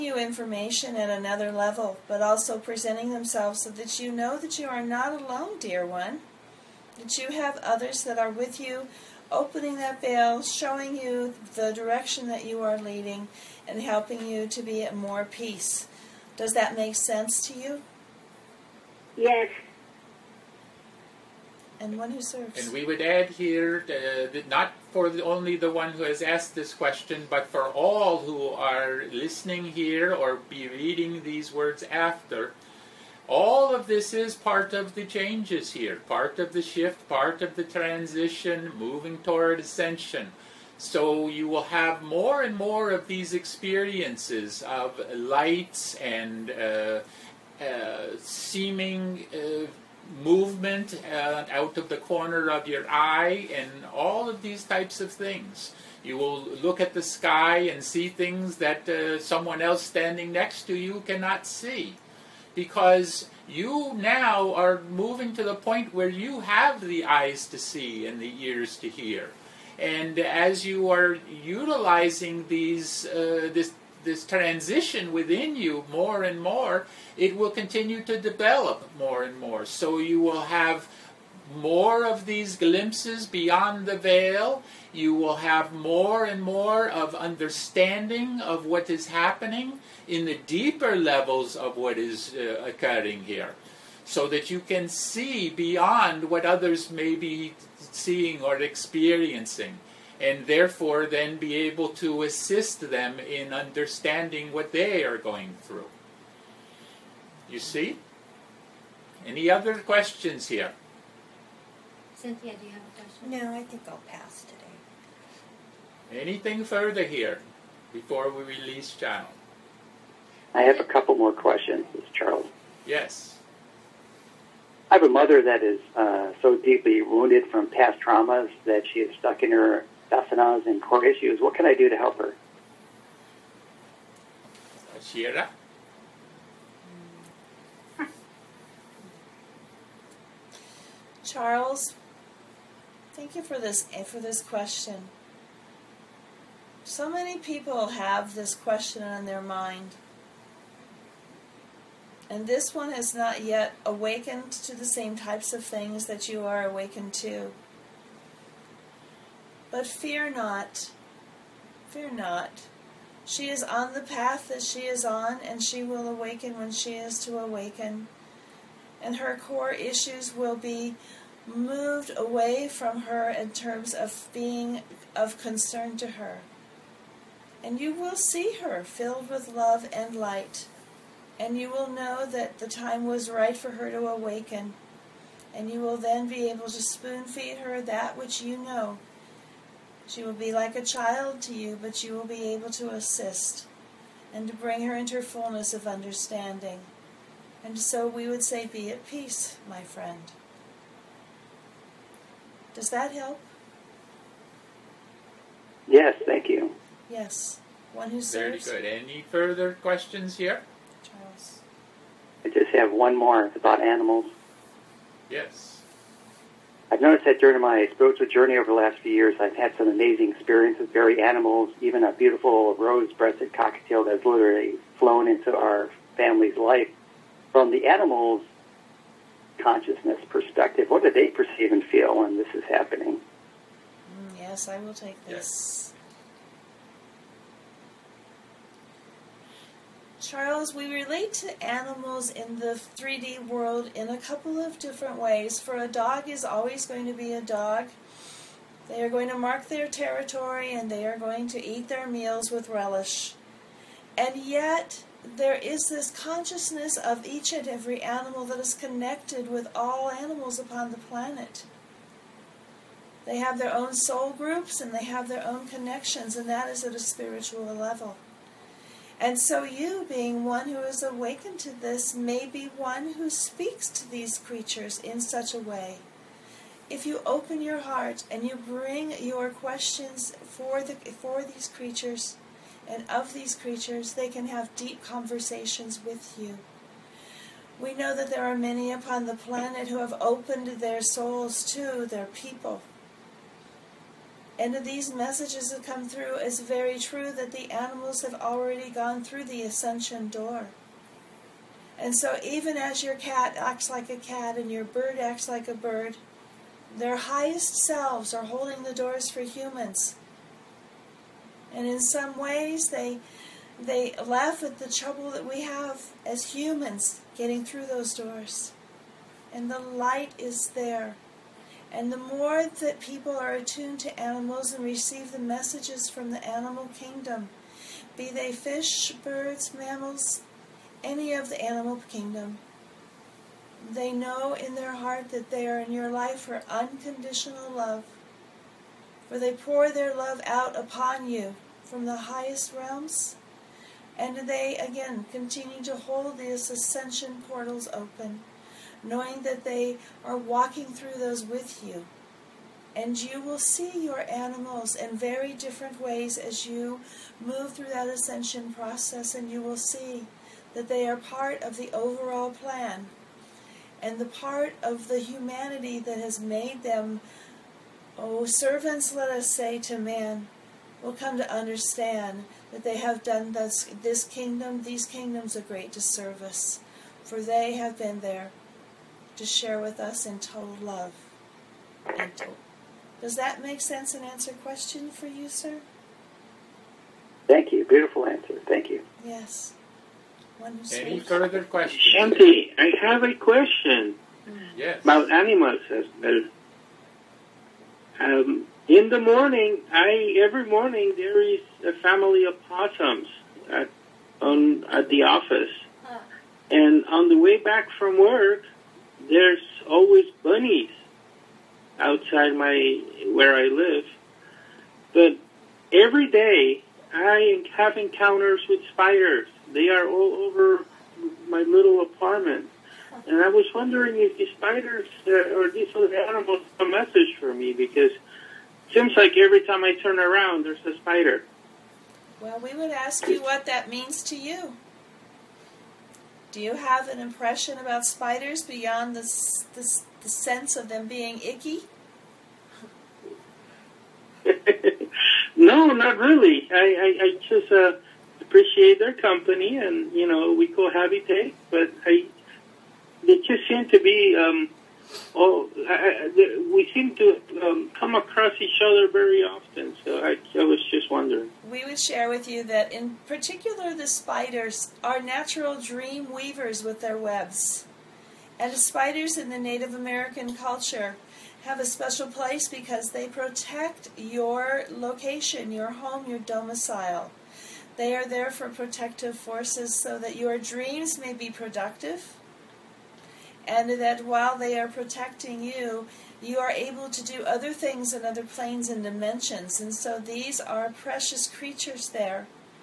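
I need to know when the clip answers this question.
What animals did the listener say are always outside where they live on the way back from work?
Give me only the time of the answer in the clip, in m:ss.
6:50.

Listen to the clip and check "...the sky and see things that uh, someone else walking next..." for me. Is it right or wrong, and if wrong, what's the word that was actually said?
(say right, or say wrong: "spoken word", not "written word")
wrong: "standing", not "walking".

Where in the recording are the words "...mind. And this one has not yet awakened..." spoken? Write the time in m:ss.
2:29.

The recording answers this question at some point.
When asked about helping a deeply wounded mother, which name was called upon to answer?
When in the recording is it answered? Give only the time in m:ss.
2:14.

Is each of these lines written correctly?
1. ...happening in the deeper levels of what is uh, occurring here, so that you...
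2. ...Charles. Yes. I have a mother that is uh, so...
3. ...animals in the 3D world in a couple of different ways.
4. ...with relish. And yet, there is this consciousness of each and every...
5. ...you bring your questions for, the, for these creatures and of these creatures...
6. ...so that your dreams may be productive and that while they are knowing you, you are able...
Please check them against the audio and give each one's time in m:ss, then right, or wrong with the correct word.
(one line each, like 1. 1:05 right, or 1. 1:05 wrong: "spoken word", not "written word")
1. 1:29 right
2. 2:02 right
3. 4:01 right
4. 4:12 right
5. 4:38 right
6. 7:59 wrong: "protecting", not "knowing".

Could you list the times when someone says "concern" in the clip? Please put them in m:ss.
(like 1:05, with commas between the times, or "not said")
2:55.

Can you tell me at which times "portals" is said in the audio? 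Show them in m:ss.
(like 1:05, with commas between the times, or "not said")
5:47.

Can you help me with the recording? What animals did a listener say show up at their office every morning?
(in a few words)
Possums.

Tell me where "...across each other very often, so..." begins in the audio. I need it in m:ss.
7:38.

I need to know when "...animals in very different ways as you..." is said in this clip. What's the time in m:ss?
5:54.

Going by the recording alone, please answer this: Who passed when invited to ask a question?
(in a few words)
Cynthia.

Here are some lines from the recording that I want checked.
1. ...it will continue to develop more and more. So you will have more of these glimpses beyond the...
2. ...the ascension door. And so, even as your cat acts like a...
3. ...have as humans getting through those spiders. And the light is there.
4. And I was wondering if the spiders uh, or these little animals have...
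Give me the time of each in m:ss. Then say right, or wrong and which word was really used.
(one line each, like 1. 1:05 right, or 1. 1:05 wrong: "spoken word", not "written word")
1. 1:17 right
2. 4:59 right
3. 5:15 wrong: "doors", not "spiders"
4. 7:03 right.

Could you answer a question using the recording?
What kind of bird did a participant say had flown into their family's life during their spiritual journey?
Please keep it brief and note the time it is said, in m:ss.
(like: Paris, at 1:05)
Rose-breasted cockatiel, at 3:42.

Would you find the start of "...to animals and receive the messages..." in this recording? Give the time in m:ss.
5:24.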